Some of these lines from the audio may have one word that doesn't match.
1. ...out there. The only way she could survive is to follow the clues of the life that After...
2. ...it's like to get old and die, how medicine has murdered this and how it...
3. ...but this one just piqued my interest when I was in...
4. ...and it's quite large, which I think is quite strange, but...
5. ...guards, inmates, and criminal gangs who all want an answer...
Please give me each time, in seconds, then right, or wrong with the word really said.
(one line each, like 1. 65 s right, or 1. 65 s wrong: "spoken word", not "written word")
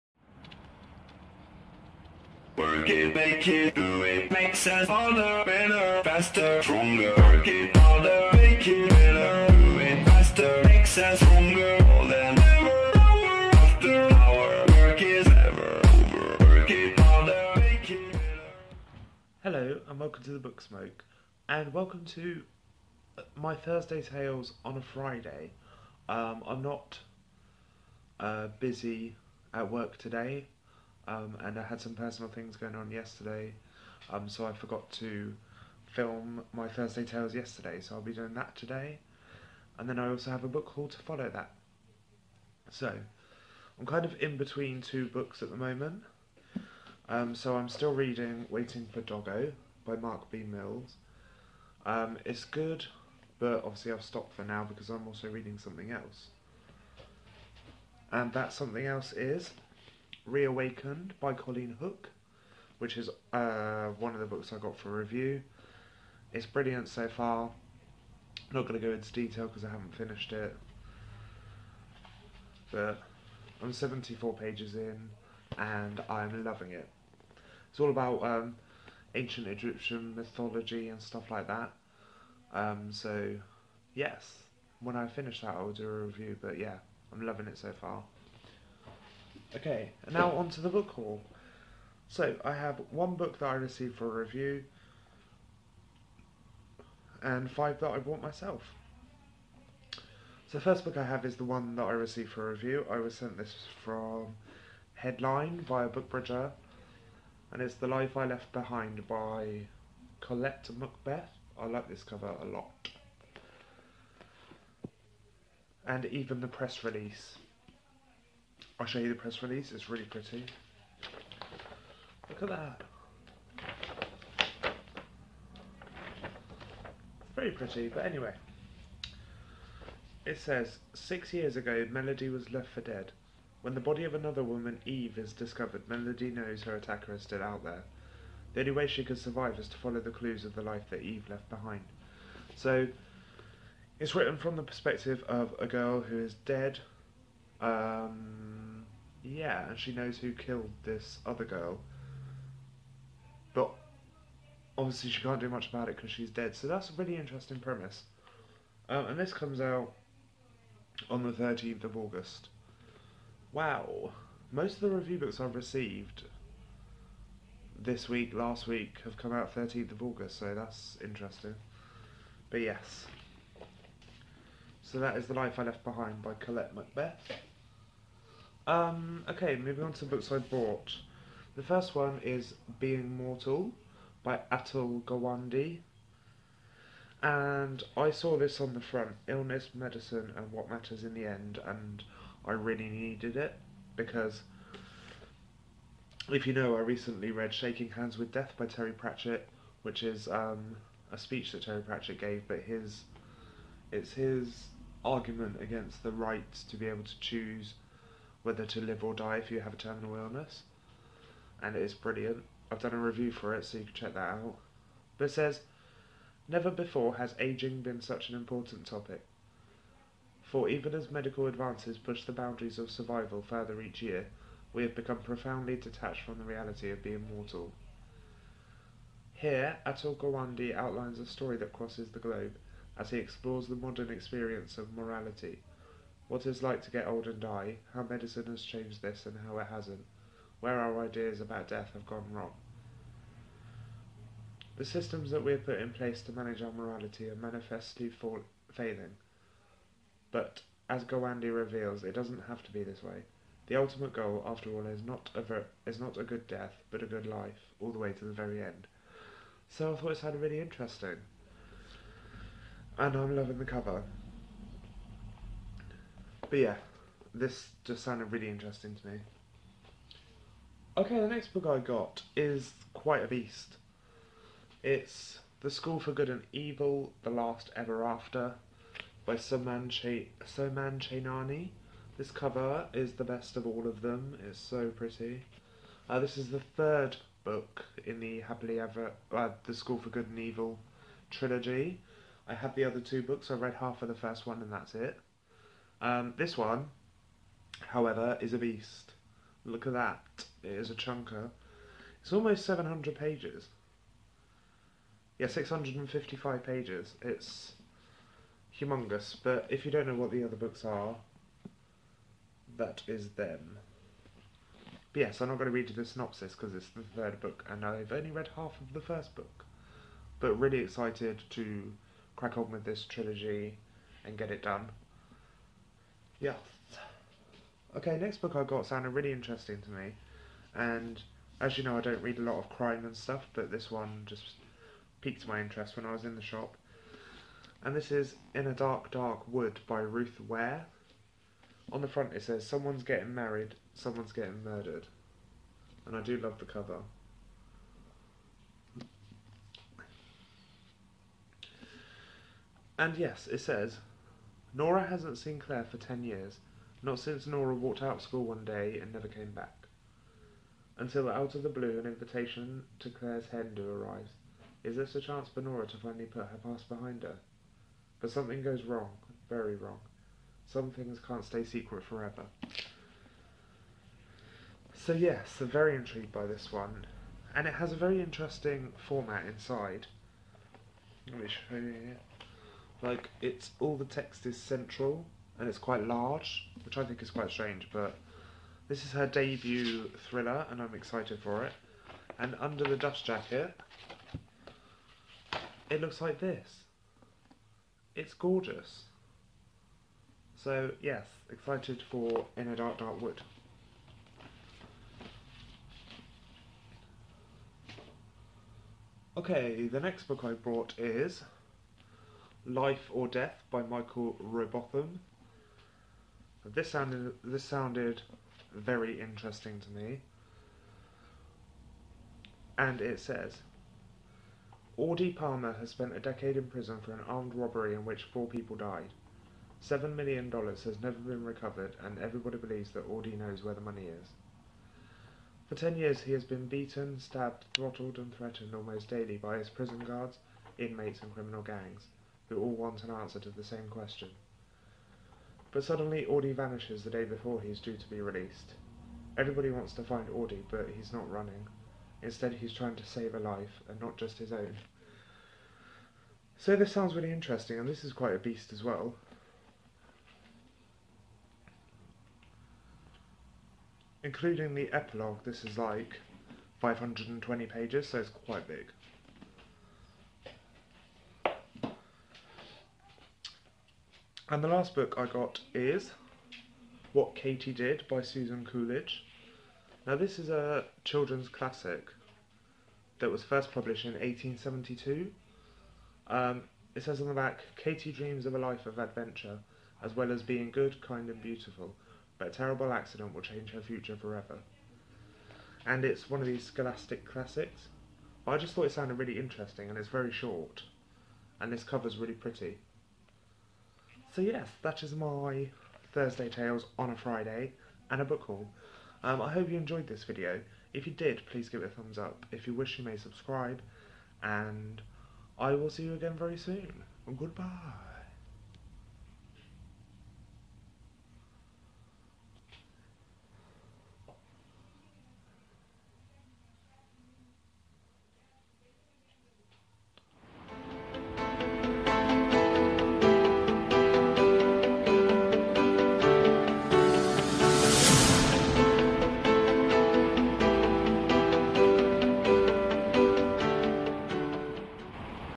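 1. 137 s wrong: "Eve", not "After"
2. 236 s wrong: "changed", not "murdered"
3. 333 s right
4. 385 s right
5. 440 s right.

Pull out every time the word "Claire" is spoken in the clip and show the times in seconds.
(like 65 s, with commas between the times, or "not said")
355 s, 363 s.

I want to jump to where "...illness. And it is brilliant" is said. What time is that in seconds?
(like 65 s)
210 s.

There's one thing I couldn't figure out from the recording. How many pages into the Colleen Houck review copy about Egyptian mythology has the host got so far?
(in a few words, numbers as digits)
74.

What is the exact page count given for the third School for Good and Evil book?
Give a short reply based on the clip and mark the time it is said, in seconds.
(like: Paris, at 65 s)
655, at 305 s.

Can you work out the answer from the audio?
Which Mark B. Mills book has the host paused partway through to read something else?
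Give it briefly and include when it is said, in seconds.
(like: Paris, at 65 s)
Waiting for Doggo, at 48 s.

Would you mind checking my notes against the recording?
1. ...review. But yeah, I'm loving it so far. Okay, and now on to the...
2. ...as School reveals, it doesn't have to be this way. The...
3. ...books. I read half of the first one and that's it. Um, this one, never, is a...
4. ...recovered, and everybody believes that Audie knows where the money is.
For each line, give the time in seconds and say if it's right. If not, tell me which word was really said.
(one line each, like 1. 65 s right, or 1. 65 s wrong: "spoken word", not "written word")
1. 86 s right
2. 250 s wrong: "Gawande", not "School"
3. 293 s wrong: "however", not "never"
4. 431 s right.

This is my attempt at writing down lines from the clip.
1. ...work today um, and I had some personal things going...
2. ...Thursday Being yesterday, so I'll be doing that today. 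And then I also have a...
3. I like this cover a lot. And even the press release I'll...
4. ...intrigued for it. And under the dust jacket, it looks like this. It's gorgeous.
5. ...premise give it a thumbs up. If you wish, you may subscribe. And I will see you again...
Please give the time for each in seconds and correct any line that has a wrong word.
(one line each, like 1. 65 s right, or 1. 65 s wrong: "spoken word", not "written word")
1. 29 s right
2. 36 s wrong: "Tales", not "Being"
3. 111 s right
4. 390 s wrong: "excited", not "intrigued"
5. 511 s wrong: "please", not "premise".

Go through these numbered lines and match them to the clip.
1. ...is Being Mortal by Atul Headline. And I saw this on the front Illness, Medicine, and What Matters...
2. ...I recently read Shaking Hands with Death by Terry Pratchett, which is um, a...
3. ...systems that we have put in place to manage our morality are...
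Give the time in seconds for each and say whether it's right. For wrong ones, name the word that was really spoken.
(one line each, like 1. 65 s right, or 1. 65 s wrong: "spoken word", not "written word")
1. 182 s wrong: "Gawande", not "Headline"
2. 196 s right
3. 244 s right.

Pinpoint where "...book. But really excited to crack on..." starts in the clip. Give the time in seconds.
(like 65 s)
319 s.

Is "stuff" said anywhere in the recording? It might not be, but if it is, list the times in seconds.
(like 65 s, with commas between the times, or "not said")
81 s, 333 s.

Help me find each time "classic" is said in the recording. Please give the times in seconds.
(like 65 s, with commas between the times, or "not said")
481 s, 497 s.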